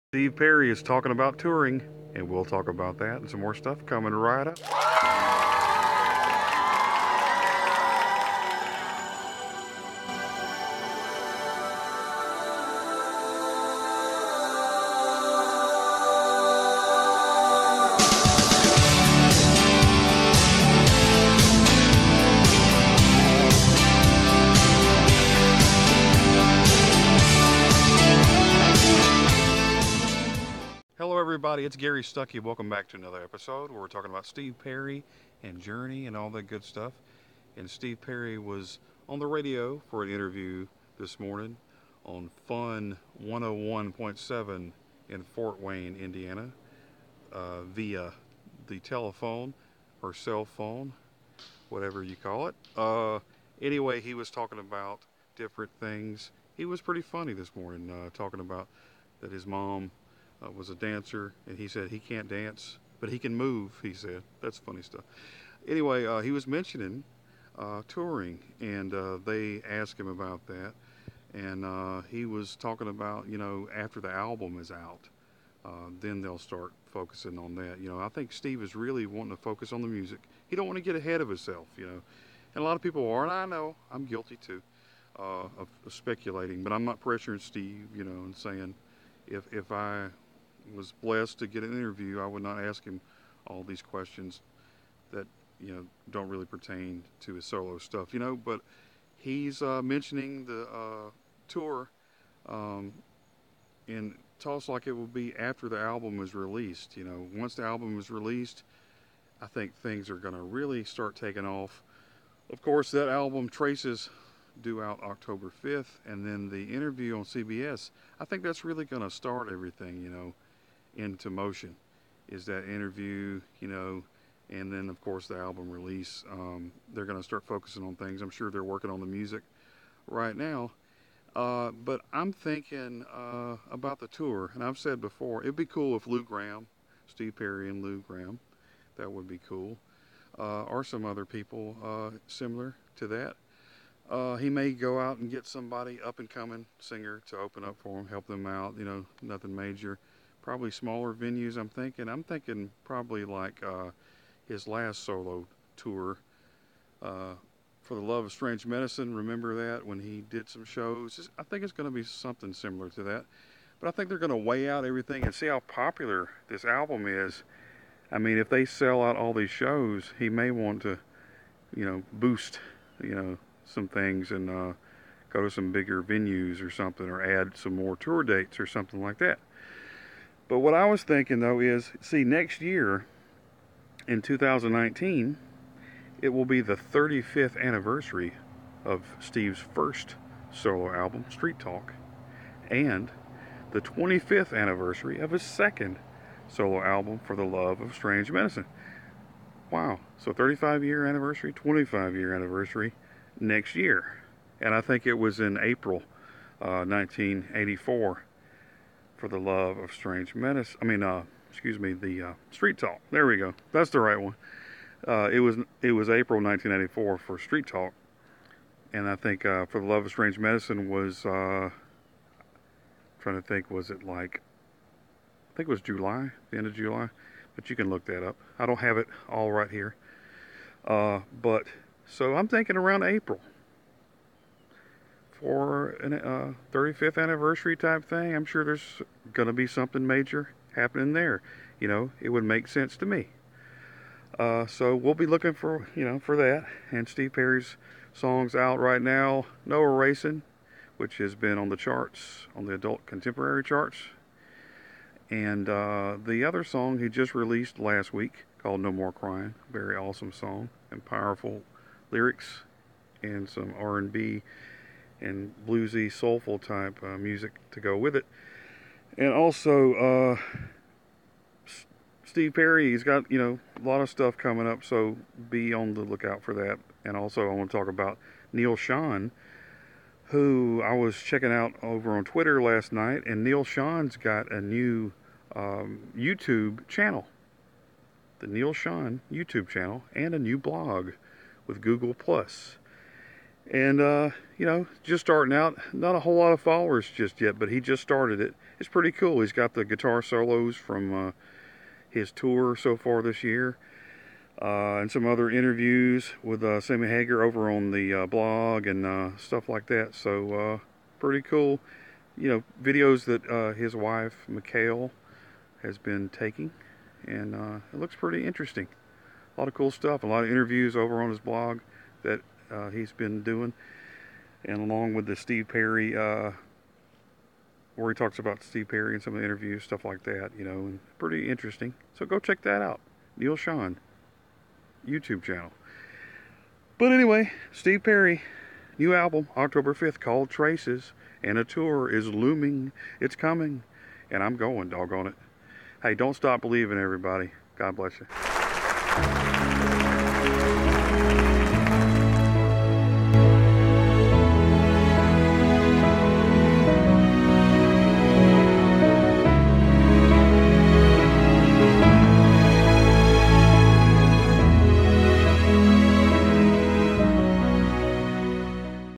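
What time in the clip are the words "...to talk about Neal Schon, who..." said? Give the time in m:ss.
4:37.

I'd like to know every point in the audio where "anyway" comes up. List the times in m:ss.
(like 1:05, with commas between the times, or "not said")
0:53, 1:05, 5:37.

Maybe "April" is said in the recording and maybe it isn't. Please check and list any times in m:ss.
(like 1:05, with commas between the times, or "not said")
3:25, 3:36, 3:53.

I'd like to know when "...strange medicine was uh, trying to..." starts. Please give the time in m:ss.
3:40.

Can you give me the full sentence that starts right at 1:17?
You know, I think Steve is really wanting to focus on the music.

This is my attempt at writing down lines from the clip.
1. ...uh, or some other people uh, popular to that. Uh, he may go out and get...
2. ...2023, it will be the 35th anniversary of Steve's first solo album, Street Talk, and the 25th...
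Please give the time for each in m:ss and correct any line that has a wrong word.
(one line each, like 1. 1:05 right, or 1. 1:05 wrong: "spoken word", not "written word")
1. 2:20 wrong: "similar", not "popular"
2. 3:04 wrong: "2019", not "2023".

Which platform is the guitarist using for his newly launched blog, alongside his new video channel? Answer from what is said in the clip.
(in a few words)
Google Plus.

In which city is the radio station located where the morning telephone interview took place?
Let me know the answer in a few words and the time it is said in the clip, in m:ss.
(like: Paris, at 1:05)
Fort Wayne, at 0:45.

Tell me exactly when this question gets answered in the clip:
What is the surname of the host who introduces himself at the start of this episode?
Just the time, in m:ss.
0:32.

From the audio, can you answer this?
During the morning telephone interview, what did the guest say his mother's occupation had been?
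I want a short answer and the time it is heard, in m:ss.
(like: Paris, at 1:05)
Dancer, at 1:00.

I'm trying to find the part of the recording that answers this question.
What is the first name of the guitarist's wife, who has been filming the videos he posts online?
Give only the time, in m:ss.
5:14.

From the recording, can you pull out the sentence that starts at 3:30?
I mean, uh, excuse me, the uh, Street Talk.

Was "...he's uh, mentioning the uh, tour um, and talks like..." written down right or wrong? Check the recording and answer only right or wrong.
right.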